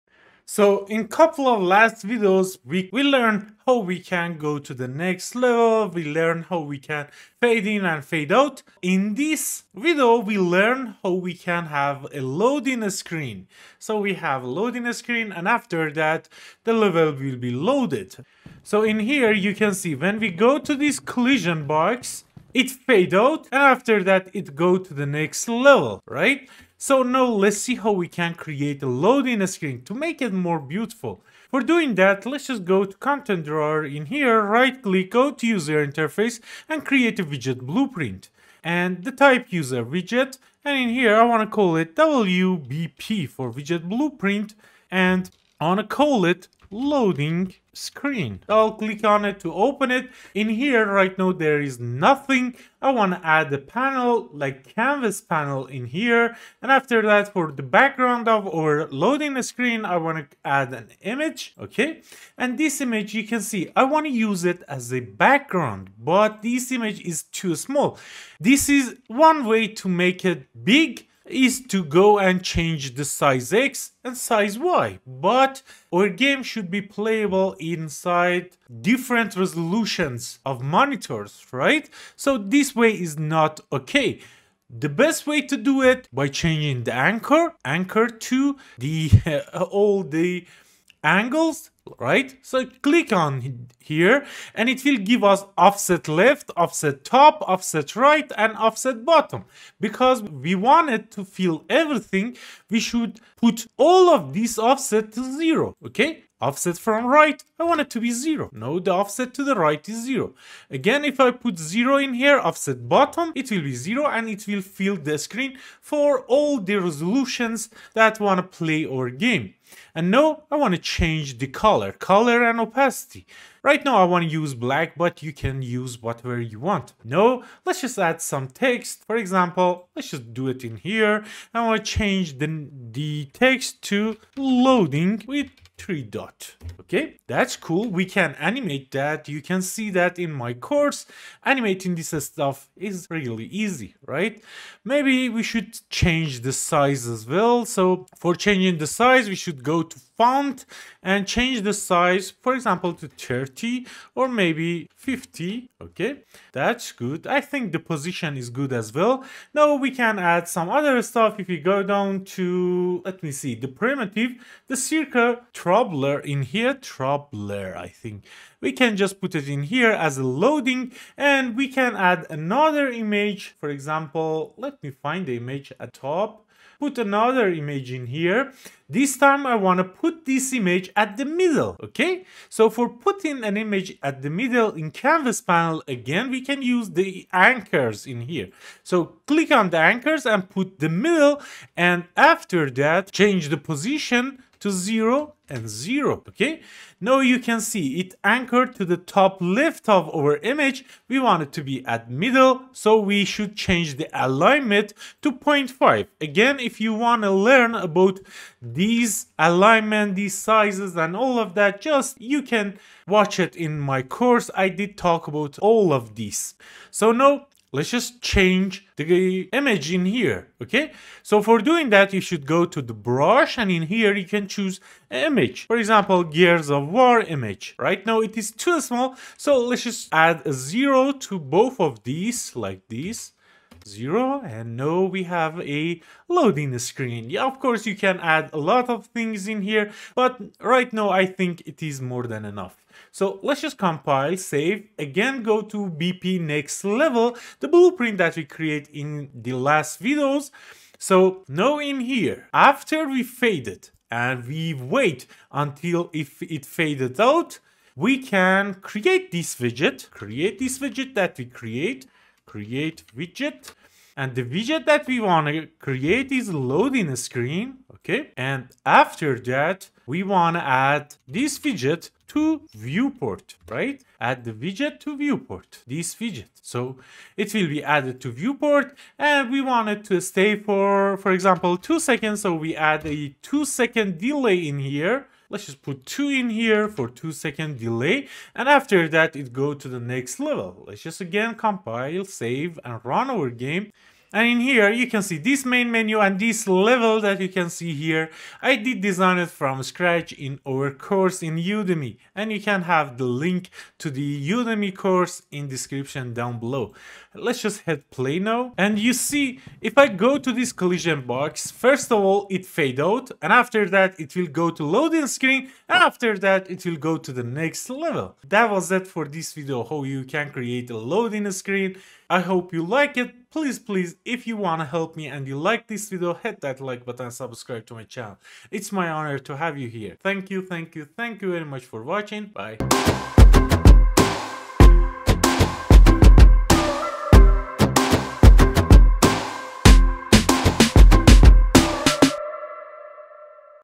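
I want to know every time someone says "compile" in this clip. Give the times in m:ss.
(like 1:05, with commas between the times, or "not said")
4:03, 4:51.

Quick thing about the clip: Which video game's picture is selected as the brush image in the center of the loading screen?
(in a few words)
Gears of War.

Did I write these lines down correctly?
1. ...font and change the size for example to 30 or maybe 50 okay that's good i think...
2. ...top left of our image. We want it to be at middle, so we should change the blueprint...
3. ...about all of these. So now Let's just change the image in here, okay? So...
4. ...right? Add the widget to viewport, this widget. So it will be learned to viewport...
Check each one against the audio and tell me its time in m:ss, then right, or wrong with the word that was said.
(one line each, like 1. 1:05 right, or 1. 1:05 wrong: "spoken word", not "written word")
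1. 2:30 right
2. 3:18 wrong: "alignment", not "blueprint"
3. 3:35 right
4. 4:33 wrong: "added", not "learned".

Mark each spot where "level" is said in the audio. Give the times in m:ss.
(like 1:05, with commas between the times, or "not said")
0:05, 0:16, 0:25, 4:06, 4:50, 4:56, 5:17.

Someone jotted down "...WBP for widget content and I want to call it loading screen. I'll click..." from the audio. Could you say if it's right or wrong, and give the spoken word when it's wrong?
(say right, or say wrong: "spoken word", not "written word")
wrong: "blueprint", not "content".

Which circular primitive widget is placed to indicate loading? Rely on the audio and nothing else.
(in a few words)
Circle throbber.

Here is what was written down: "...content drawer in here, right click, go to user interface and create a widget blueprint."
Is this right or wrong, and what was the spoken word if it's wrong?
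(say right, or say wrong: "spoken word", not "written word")
right.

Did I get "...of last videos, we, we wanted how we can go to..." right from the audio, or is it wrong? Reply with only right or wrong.
wrong.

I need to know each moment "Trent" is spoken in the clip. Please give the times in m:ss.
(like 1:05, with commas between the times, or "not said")
not said.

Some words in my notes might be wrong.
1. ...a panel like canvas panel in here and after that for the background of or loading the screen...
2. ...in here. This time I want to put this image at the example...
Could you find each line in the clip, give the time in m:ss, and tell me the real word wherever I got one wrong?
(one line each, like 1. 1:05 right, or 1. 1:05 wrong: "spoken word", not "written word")
1. 0:53 right
2. 2:57 wrong: "middle", not "example".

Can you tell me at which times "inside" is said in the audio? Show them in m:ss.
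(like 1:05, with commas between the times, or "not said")
1:17.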